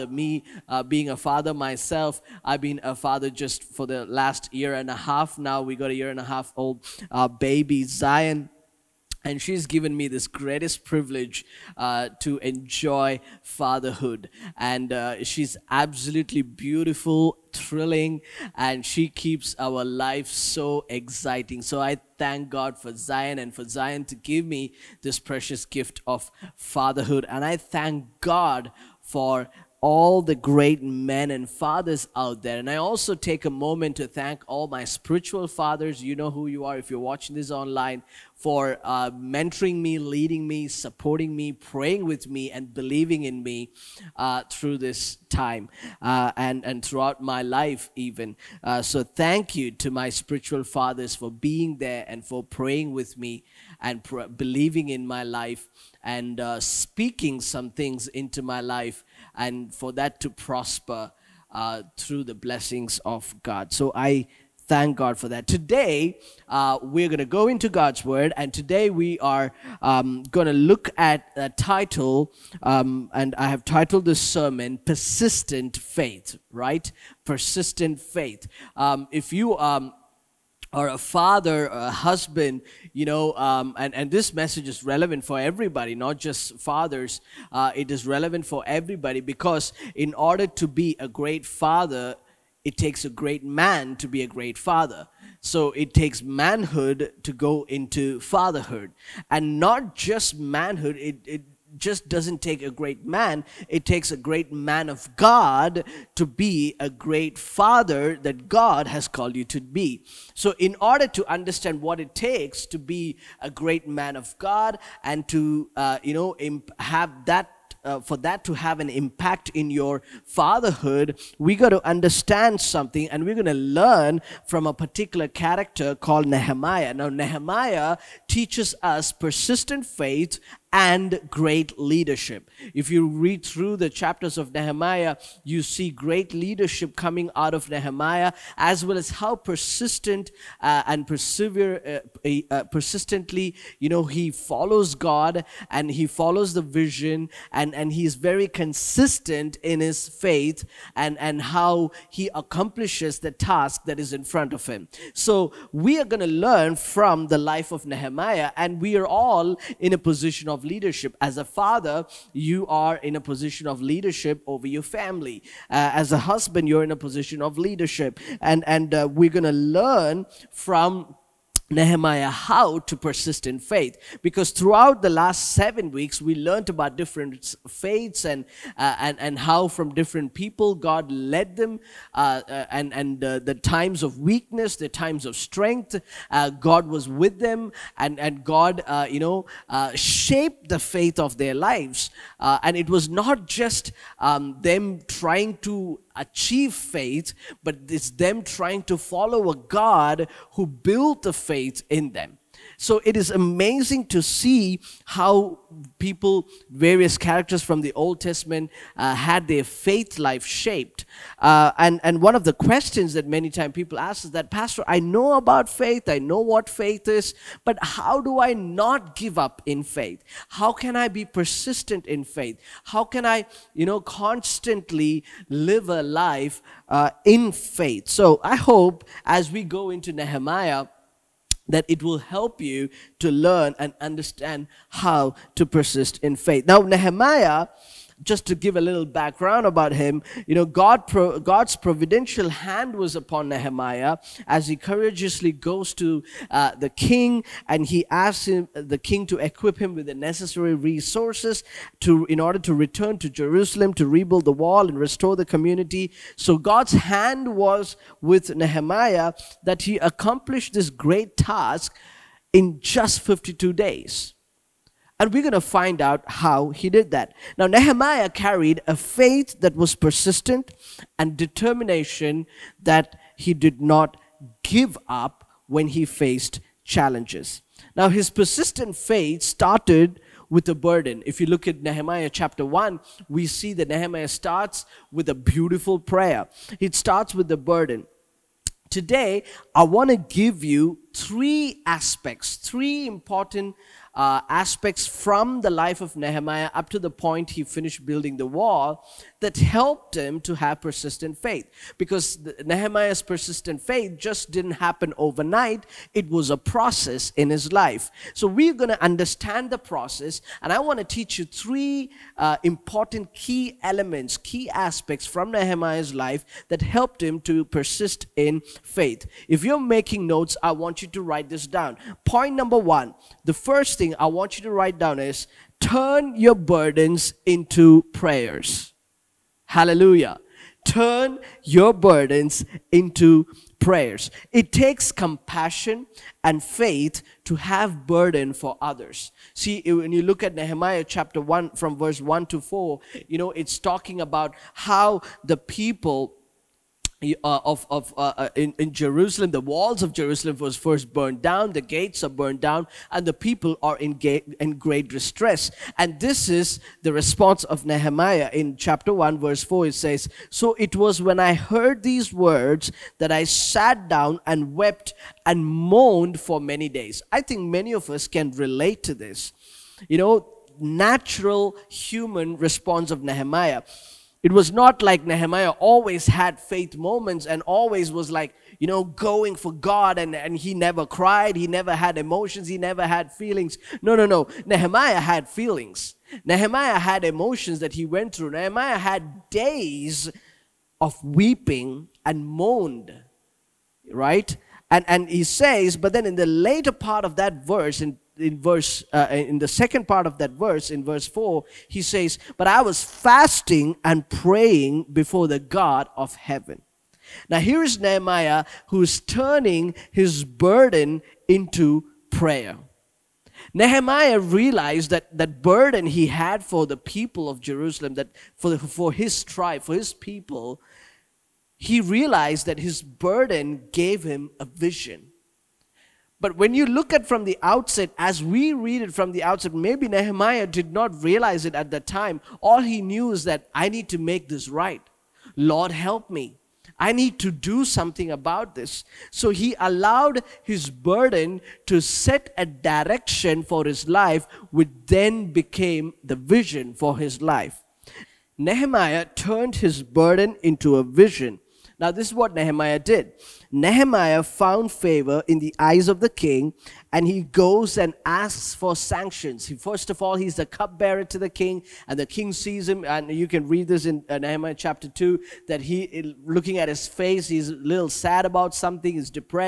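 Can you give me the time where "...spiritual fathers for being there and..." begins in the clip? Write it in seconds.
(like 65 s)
50 s.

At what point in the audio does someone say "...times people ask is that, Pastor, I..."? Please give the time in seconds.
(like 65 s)
213 s.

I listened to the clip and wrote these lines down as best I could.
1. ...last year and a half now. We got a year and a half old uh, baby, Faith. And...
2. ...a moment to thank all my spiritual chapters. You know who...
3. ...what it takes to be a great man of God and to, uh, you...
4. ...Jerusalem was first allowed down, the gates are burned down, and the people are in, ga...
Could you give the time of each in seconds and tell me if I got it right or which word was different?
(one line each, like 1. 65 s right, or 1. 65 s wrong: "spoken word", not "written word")
1. 4 s wrong: "Zion", not "Faith"
2. 33 s wrong: "fathers", not "chapters"
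3. 111 s right
4. 350 s wrong: "burned", not "allowed".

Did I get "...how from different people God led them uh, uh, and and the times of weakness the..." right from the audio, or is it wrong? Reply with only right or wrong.
right.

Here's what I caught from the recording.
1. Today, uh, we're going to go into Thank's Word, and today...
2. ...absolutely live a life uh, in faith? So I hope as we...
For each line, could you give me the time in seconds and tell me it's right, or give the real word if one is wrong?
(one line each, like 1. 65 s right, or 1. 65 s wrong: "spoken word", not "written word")
1. 65 s wrong: "God", not "Thank"
2. 223 s wrong: "constantly", not "absolutely".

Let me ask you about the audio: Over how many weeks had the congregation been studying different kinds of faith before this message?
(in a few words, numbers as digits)
7.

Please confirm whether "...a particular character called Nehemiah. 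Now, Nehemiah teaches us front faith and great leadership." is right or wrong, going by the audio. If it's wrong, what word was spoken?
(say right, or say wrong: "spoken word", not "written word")
wrong: "persistent", not "front".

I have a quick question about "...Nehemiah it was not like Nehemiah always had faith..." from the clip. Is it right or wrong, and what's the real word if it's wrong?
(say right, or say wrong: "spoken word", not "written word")
right.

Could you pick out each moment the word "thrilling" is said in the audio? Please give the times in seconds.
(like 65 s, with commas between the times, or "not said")
17 s.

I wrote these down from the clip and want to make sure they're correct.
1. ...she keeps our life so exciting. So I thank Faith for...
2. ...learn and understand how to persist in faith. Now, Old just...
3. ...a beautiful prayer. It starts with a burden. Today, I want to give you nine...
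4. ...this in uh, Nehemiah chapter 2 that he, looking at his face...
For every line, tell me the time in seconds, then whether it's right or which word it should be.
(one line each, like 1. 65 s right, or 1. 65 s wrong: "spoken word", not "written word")
1. 18 s wrong: "God", not "Faith"
2. 233 s wrong: "Nehemiah", not "Old"
3. 285 s wrong: "three", not "nine"
4. 463 s right.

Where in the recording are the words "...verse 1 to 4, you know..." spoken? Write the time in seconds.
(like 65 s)
341 s.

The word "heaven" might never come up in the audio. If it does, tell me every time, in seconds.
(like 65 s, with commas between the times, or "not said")
406 s.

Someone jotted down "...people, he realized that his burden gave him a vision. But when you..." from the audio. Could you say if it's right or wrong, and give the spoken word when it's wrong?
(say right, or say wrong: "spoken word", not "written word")
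right.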